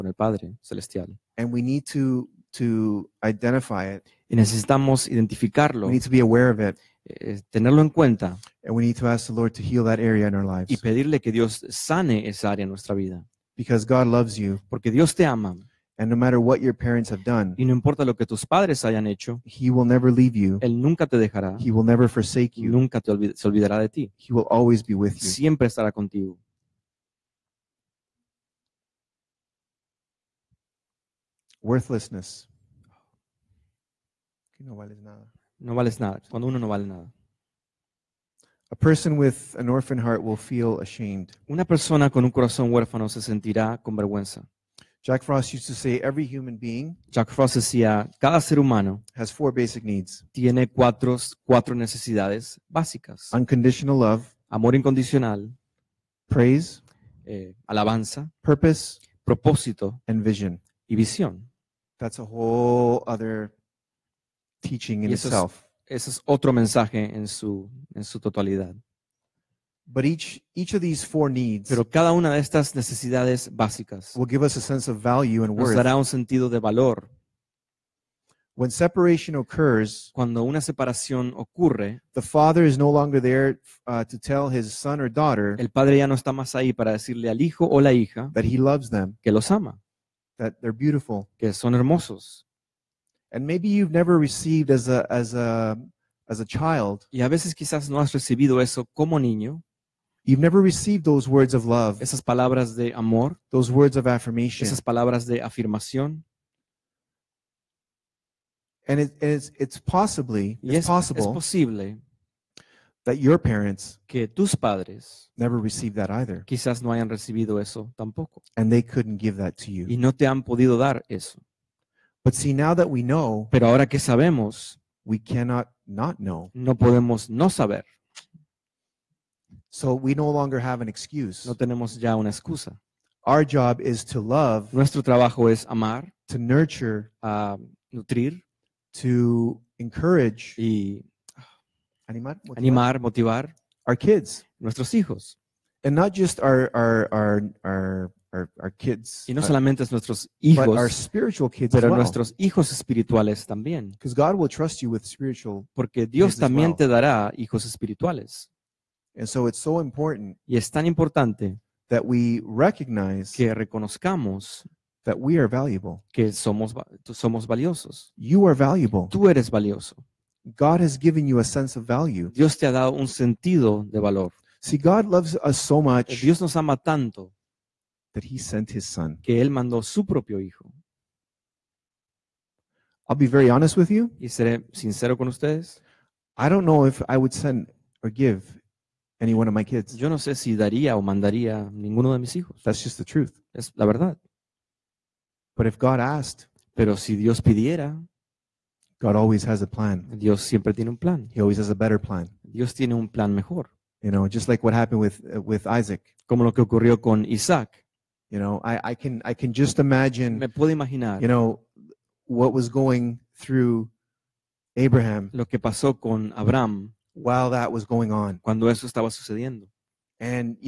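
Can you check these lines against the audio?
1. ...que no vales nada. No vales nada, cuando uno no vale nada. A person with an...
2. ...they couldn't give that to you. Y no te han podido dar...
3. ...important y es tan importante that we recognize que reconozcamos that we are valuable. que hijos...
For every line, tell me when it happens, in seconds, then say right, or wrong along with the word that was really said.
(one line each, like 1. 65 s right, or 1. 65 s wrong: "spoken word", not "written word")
1. 34 s right
2. 118 s right
3. 159 s wrong: "somos", not "hijos".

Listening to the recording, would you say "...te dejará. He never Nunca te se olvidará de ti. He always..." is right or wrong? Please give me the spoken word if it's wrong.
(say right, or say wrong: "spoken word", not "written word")
right.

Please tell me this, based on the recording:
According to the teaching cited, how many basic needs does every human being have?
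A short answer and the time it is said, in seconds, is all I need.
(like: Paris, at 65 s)
4, at 49 s.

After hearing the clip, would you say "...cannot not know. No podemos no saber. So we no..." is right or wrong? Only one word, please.
right.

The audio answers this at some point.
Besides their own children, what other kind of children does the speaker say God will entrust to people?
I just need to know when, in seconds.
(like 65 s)
150 s.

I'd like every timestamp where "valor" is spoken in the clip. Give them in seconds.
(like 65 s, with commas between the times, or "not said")
76 s, 174 s.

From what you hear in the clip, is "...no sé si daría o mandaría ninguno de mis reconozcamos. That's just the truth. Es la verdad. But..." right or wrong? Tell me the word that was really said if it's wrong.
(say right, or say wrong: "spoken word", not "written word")
wrong: "hijos", not "reconozcamos".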